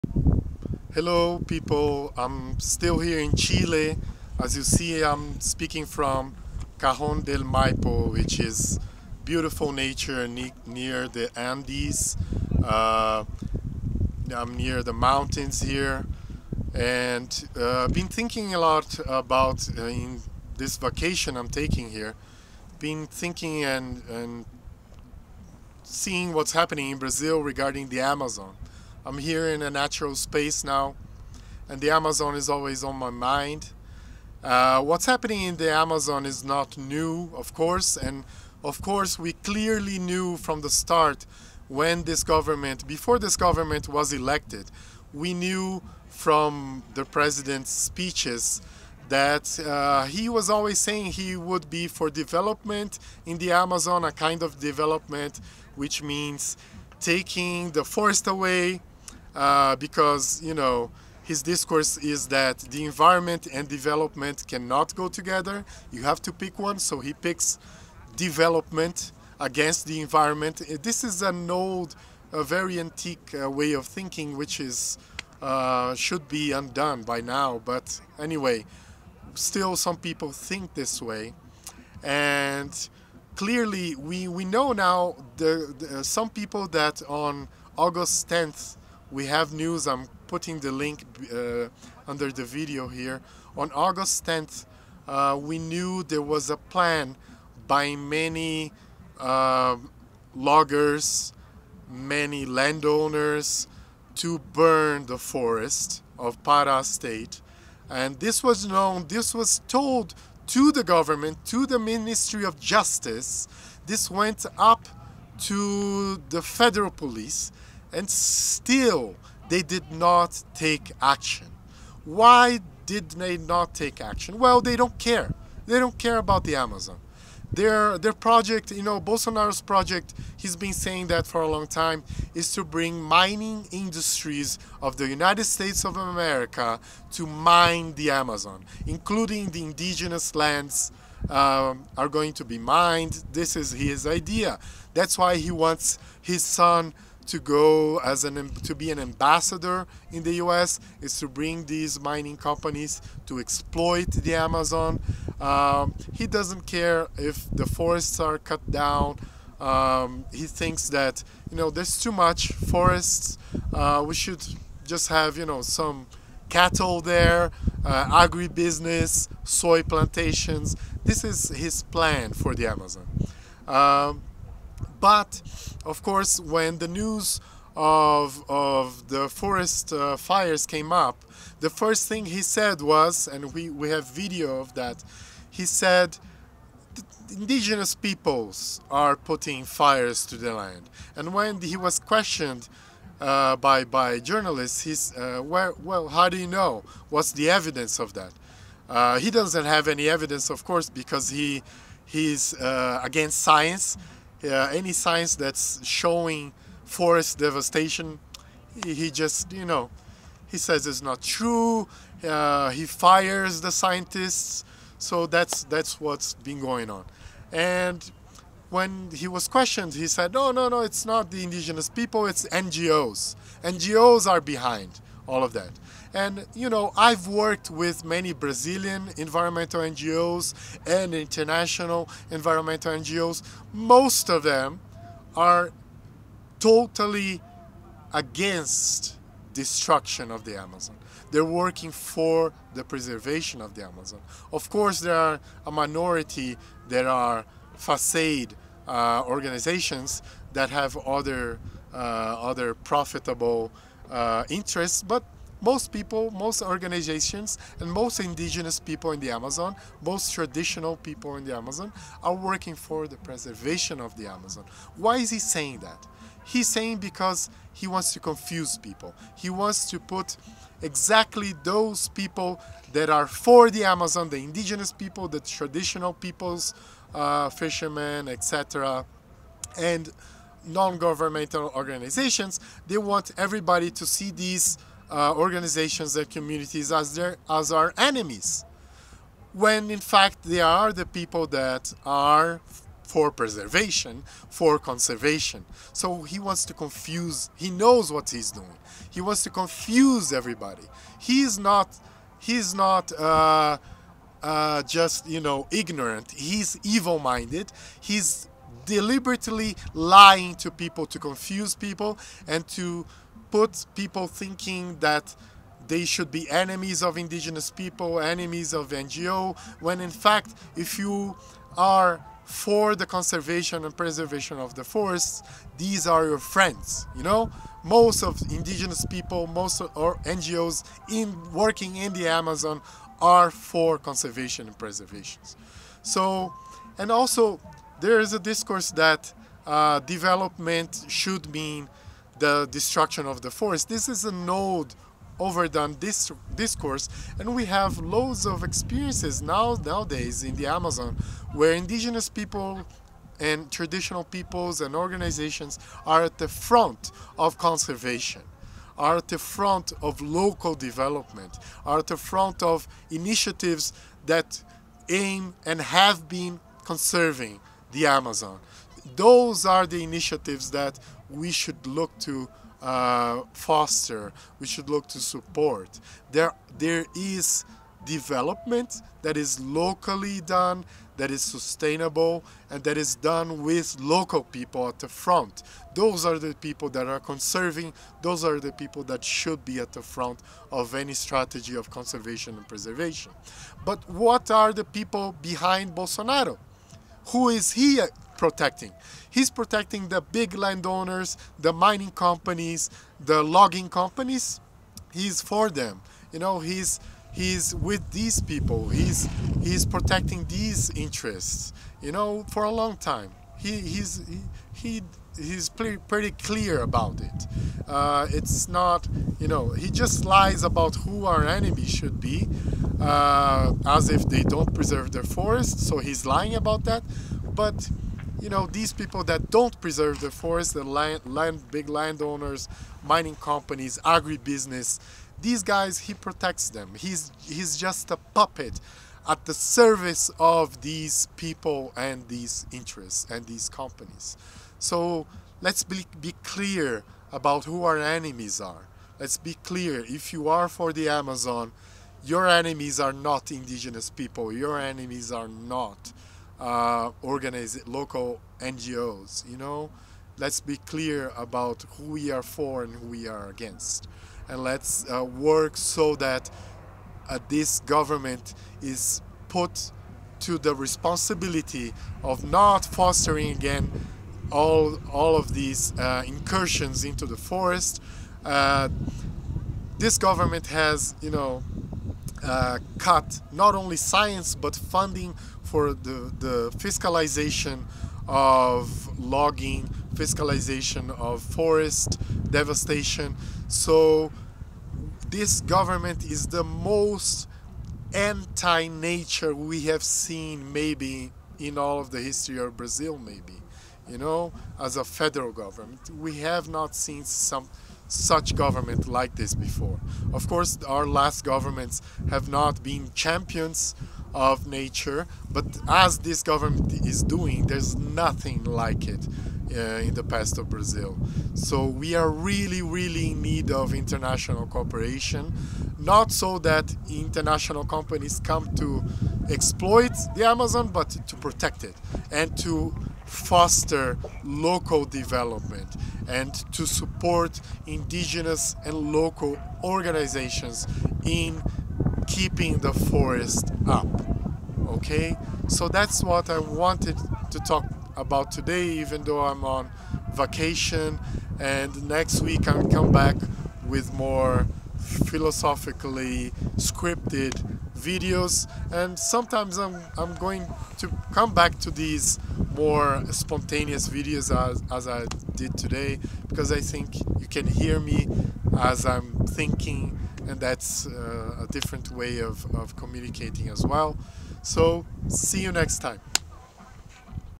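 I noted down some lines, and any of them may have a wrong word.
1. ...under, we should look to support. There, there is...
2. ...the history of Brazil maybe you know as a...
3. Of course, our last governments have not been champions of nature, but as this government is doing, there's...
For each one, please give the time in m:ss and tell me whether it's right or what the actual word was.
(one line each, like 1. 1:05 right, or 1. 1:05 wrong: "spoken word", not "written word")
1. 6:13 wrong: "foster", not "under"
2. 8:22 right
3. 8:30 right.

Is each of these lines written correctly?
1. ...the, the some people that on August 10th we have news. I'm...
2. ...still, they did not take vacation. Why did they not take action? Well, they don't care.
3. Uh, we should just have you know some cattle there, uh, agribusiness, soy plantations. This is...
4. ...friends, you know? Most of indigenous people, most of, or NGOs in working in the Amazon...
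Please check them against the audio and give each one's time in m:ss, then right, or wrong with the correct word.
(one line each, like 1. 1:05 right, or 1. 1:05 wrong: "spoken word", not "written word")
1. 1:25 right
2. 1:58 wrong: "action", not "vacation"
3. 2:43 right
4. 5:26 right.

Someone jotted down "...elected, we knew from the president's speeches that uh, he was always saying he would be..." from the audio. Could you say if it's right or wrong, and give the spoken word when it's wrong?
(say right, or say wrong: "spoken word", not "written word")
right.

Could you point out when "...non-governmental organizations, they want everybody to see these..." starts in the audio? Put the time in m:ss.
4:40.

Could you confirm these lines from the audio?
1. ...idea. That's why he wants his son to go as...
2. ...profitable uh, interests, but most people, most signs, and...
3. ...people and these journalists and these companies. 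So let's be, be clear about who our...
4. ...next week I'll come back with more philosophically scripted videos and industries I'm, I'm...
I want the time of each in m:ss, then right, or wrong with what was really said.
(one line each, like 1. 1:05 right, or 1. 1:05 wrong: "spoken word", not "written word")
1. 2:24 right
2. 4:12 wrong: "organizations", not "signs"
3. 7:21 wrong: "interests", not "journalists"
4. 9:12 wrong: "sometimes", not "industries".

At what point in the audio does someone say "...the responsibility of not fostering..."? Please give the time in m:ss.
7:50.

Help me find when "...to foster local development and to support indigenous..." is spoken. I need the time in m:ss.
8:52.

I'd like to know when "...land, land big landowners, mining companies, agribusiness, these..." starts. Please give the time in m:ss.
7:10.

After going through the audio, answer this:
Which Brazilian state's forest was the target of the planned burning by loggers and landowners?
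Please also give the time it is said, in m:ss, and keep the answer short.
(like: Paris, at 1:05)
Para, at 1:46.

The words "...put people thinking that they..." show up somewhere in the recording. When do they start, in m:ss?
5:13.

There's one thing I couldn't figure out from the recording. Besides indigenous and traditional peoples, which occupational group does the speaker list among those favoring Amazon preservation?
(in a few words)
Fishermen.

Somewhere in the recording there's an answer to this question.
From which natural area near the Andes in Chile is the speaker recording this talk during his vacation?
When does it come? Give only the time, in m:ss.
0:06.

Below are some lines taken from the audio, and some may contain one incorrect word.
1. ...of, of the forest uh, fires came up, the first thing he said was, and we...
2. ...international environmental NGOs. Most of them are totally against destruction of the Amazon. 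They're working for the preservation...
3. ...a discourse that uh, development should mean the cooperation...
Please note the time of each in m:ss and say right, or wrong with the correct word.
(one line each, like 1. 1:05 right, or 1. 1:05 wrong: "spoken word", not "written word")
1. 2:57 right
2. 3:51 right
3. 5:38 wrong: "destruction", not "cooperation".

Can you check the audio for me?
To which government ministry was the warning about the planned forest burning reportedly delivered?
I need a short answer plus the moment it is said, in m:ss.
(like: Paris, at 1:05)
Ministry of Justice, at 1:51.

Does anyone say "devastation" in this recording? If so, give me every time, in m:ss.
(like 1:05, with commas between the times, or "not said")
3:27, 8:12.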